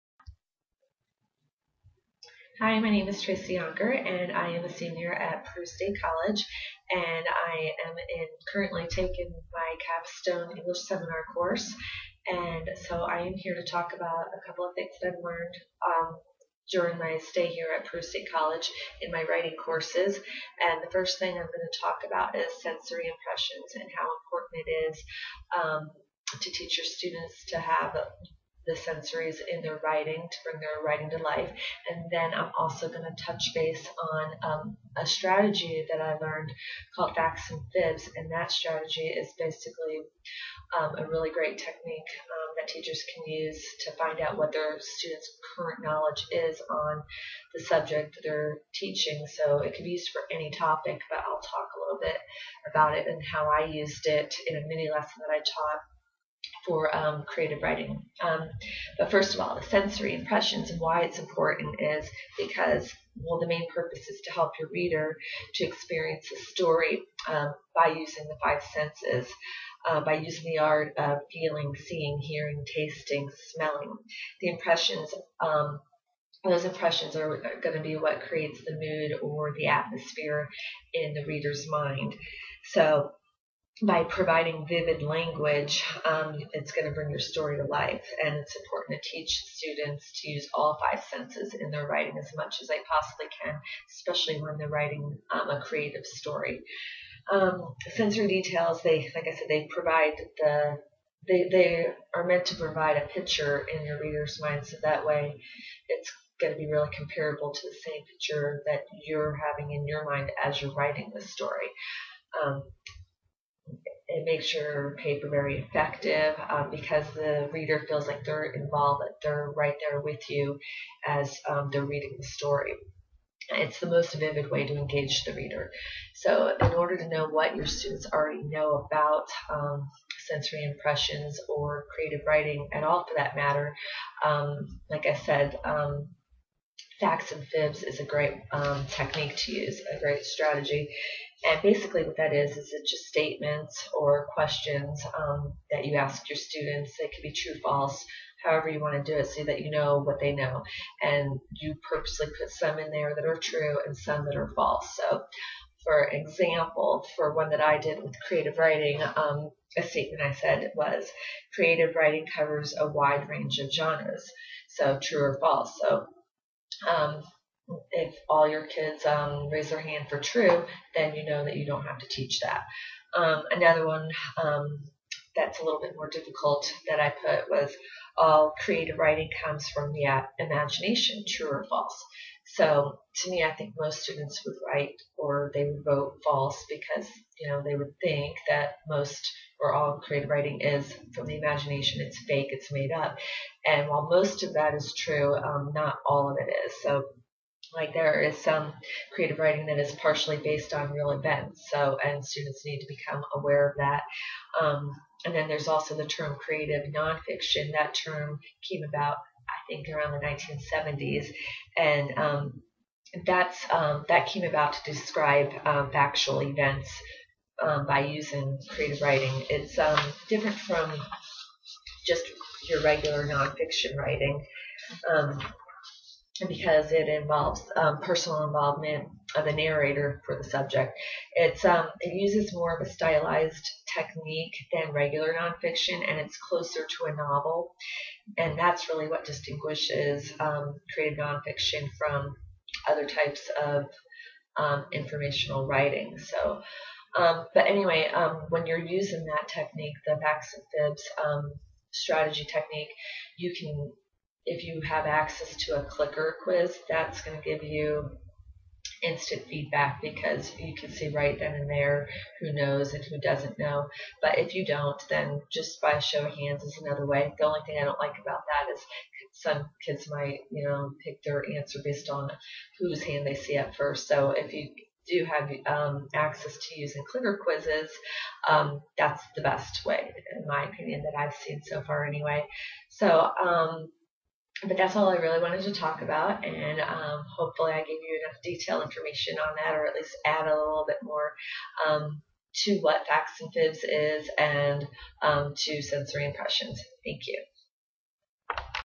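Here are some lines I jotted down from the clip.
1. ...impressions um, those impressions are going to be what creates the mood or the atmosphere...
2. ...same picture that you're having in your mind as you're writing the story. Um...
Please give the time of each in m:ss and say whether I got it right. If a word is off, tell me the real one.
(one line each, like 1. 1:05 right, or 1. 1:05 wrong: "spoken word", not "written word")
1. 1:14 right
2. 1:47 right.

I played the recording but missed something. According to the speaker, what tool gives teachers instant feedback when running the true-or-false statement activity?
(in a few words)
Clicker quiz.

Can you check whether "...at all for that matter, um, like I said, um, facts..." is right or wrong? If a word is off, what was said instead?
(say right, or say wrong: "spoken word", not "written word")
right.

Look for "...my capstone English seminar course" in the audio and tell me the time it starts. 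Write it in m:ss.
0:09.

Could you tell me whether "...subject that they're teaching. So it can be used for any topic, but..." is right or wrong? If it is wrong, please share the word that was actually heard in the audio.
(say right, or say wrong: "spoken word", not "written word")
right.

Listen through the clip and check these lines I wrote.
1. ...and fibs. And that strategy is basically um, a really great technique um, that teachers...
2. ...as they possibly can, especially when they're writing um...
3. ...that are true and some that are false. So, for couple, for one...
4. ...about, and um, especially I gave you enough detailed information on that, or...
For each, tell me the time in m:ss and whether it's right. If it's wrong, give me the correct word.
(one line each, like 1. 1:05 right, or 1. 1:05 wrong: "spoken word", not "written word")
1. 0:37 right
2. 1:32 right
3. 2:33 wrong: "example", not "couple"
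4. 4:46 wrong: "hopefully", not "especially".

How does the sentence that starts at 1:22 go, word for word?
So by providing vivid language, um, it's going to bring your story to life.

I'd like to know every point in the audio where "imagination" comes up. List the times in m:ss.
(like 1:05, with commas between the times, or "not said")
3:00, 3:11.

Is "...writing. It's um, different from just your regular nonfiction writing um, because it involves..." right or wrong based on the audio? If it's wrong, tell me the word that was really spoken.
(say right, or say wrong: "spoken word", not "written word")
right.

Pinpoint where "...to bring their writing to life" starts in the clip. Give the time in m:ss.
0:30.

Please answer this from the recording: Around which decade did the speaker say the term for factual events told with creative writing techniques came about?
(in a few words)
1970s.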